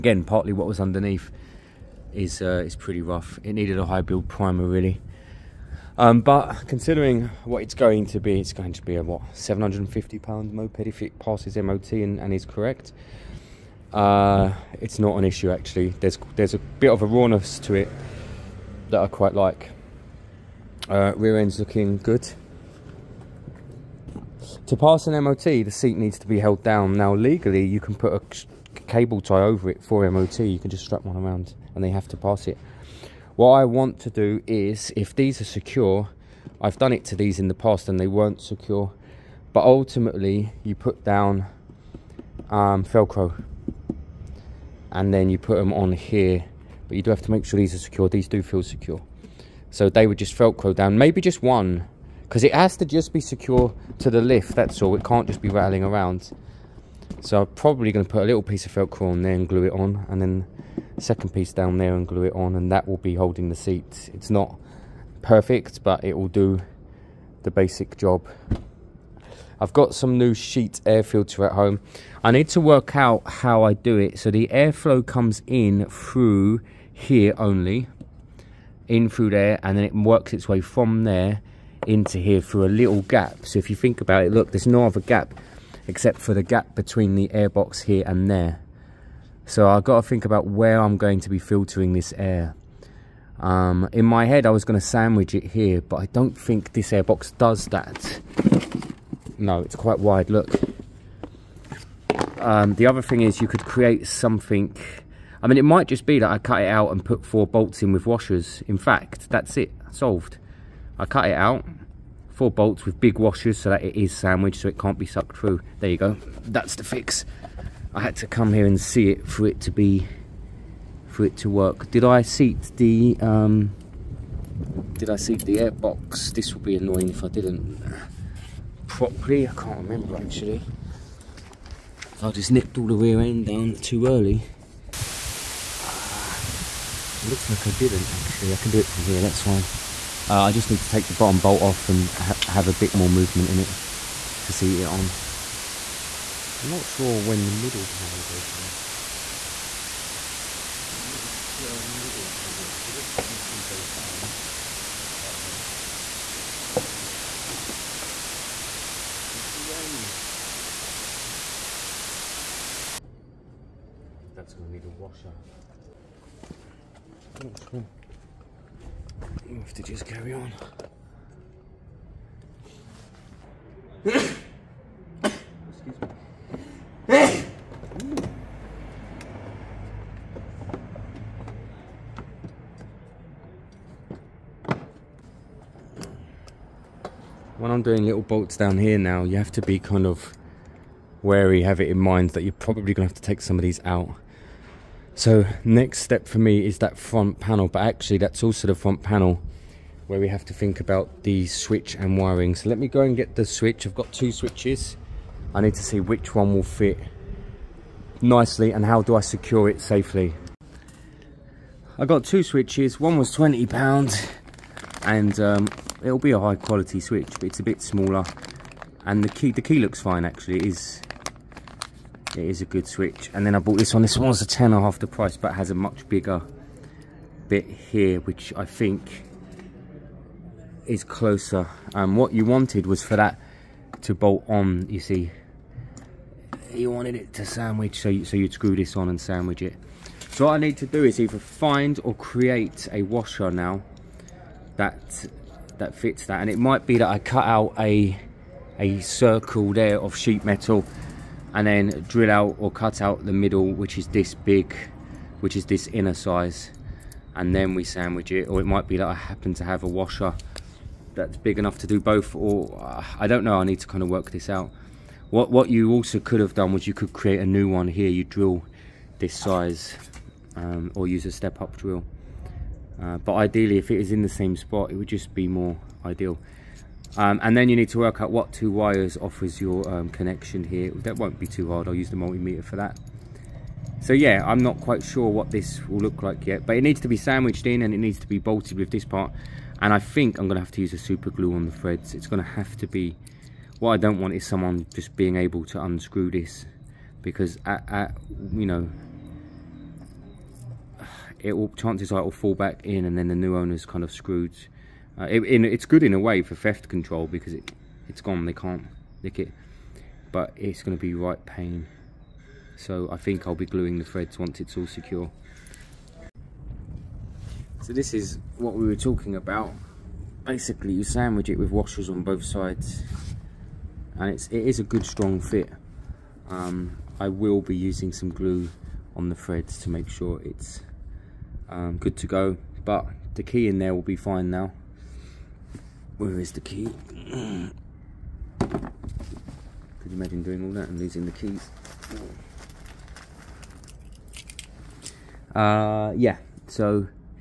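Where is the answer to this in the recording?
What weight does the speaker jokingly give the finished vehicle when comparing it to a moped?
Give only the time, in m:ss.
0:09.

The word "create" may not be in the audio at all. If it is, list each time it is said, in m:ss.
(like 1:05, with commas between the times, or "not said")
1:43, 4:02, 4:27.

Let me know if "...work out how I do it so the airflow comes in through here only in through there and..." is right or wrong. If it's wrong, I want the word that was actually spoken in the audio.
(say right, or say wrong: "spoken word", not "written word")
right.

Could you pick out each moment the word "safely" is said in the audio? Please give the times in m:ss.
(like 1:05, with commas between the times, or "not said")
3:29.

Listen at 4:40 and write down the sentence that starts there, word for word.
That won't be too hard, I'll use the multimeter for that.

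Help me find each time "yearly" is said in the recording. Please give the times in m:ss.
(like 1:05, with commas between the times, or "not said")
not said.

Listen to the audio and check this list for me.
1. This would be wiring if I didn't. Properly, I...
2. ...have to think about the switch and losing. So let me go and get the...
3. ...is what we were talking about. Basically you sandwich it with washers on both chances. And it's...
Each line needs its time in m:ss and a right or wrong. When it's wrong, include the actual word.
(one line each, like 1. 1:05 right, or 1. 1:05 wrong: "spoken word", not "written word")
1. 2:06 wrong: "annoying", not "wiring"
2. 3:20 wrong: "wiring", not "losing"
3. 5:18 wrong: "sides", not "chances".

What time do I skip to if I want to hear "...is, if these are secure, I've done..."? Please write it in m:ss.
0:34.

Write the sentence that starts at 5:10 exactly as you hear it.
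But it's going to be right pain.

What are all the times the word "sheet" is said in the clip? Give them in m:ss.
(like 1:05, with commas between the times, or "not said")
1:10, 4:10.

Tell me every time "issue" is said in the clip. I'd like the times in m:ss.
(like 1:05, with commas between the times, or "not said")
0:15.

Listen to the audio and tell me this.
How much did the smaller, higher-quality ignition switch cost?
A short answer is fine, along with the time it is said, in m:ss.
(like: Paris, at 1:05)
20 pounds, at 3:33.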